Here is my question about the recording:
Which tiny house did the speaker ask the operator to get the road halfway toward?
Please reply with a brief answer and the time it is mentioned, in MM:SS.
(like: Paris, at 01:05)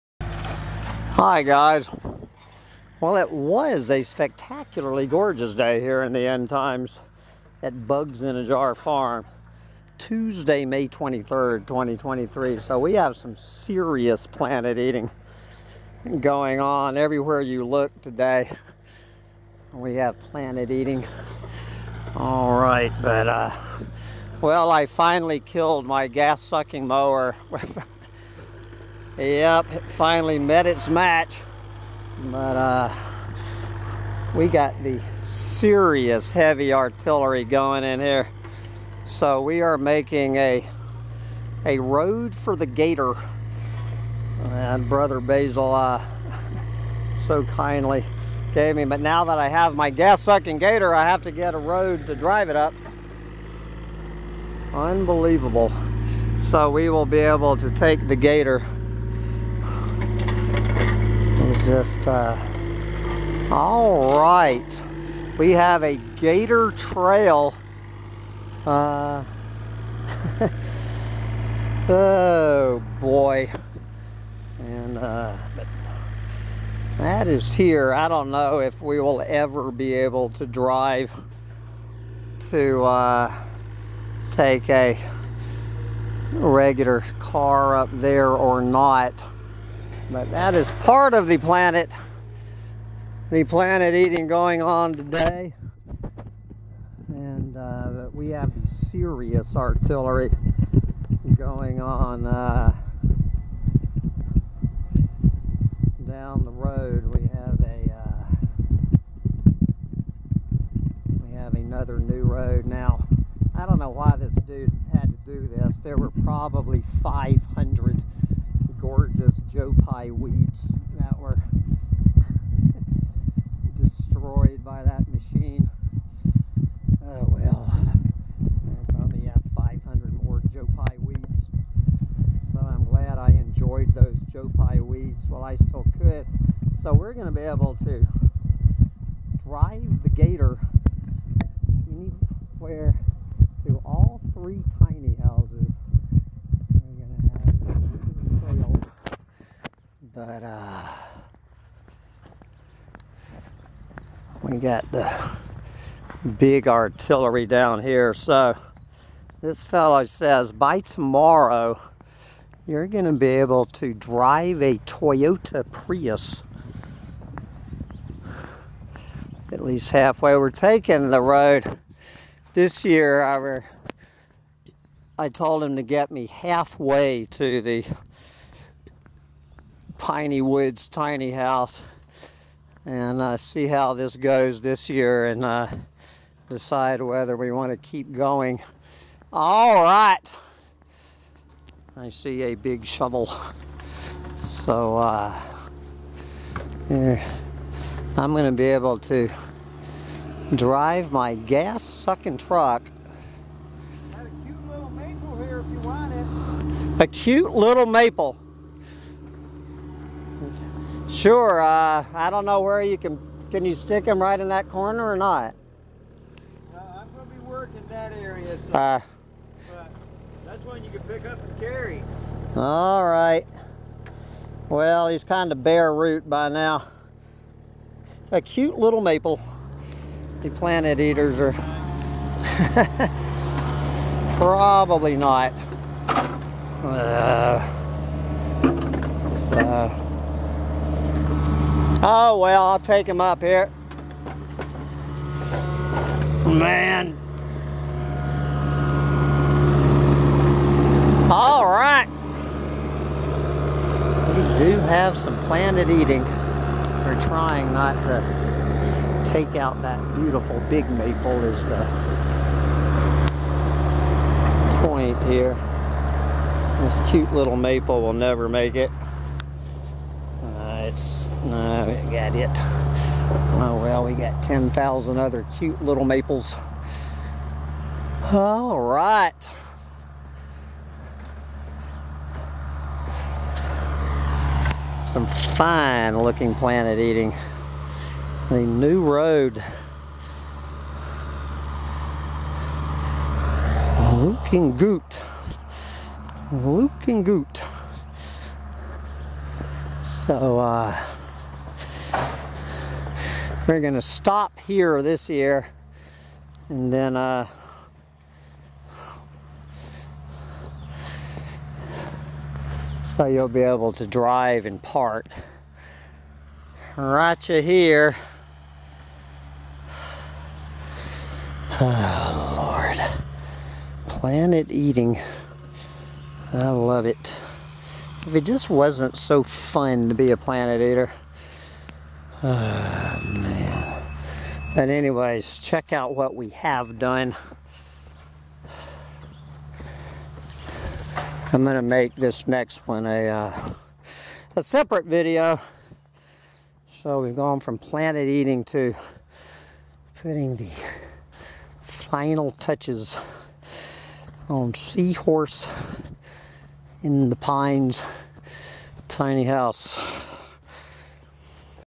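piney woods tiny house, at 03:00.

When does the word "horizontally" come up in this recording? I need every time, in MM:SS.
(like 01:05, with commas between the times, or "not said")
not said.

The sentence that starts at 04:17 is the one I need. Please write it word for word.
We're trying not to take out that beautiful big maple is the point here.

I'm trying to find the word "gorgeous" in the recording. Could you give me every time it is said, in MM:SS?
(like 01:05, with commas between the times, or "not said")
00:05, 01:58.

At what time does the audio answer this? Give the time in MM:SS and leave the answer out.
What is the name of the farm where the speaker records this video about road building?
00:07.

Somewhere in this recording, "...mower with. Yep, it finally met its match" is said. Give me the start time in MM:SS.
00:26.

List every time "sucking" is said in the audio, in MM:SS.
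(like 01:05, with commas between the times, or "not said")
00:26, 00:49, 03:21.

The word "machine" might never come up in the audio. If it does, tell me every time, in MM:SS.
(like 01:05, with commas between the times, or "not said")
02:05.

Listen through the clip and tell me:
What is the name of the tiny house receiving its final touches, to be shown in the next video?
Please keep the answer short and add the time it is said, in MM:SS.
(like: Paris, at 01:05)
Seahorse in the Pines, at 05:54.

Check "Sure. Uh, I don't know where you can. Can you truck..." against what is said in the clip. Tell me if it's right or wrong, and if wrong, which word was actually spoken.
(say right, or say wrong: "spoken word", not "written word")
wrong: "stick", not "truck".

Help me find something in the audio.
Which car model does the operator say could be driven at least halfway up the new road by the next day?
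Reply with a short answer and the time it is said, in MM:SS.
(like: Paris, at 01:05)
Toyota Prius, at 02:44.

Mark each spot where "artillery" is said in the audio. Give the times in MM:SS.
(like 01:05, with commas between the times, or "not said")
00:36, 01:39, 02:36.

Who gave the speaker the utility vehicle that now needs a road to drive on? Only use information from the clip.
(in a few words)
Brother Basil.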